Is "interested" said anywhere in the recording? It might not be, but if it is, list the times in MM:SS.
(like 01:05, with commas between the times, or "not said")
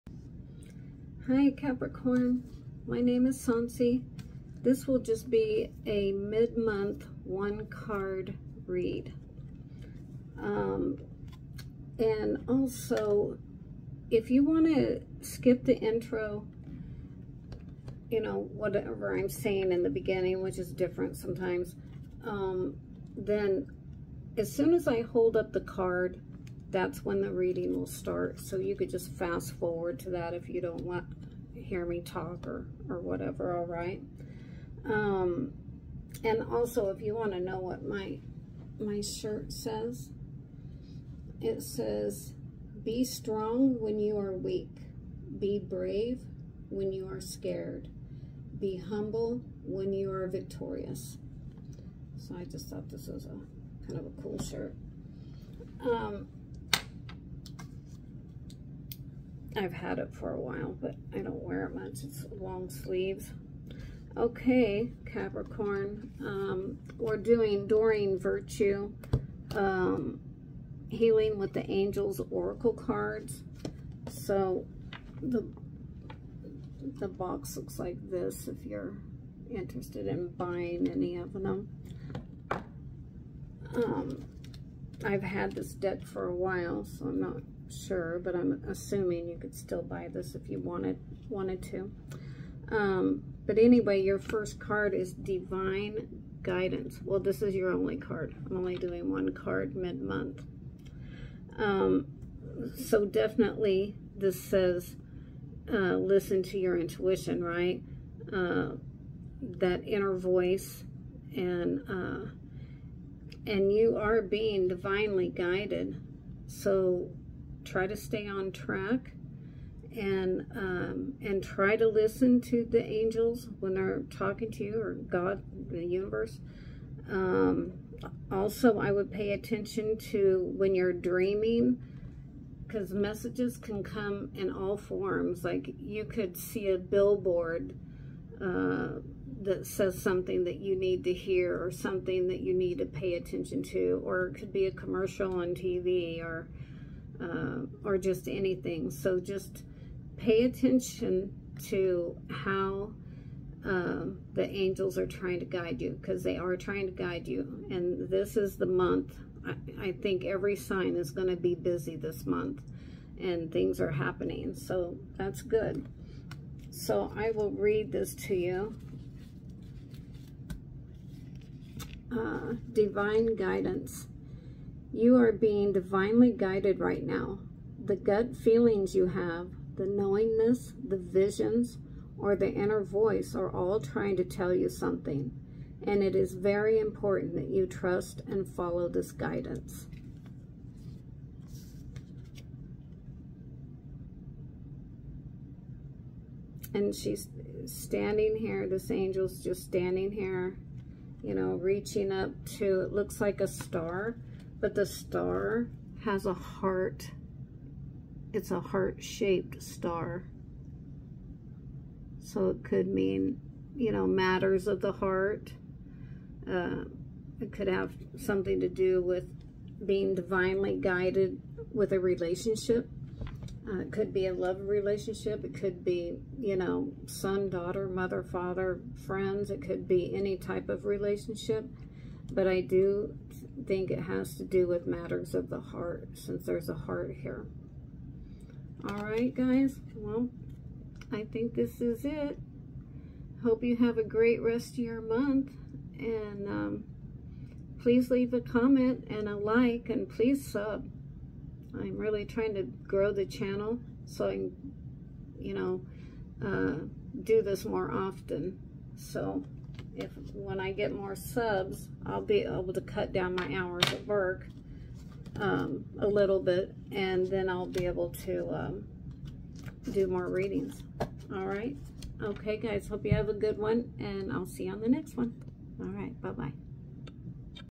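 01:19.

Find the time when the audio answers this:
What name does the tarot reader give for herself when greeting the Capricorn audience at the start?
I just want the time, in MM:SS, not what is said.
00:03.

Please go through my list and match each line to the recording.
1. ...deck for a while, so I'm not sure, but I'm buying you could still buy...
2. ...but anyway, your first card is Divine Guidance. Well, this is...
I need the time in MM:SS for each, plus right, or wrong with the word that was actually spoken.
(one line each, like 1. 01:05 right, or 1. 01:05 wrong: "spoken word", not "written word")
1. 01:25 wrong: "assuming", not "buying"
2. 01:33 right.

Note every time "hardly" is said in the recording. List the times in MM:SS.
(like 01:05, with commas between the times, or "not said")
not said.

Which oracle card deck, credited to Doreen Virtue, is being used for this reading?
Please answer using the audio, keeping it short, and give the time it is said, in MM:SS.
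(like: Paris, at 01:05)
Healing with the Angels, at 01:10.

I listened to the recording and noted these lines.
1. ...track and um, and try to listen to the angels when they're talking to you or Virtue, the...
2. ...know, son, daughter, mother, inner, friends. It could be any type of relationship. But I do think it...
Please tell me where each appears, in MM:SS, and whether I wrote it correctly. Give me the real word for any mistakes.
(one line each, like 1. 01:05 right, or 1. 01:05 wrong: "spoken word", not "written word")
1. 01:58 wrong: "God", not "Virtue"
2. 03:46 wrong: "father", not "inner".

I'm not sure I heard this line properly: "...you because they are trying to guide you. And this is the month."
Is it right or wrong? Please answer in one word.
right.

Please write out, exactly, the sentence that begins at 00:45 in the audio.
Be brave when you are scared.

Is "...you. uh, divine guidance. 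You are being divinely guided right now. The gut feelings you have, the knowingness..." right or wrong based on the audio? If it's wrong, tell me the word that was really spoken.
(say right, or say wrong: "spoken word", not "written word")
right.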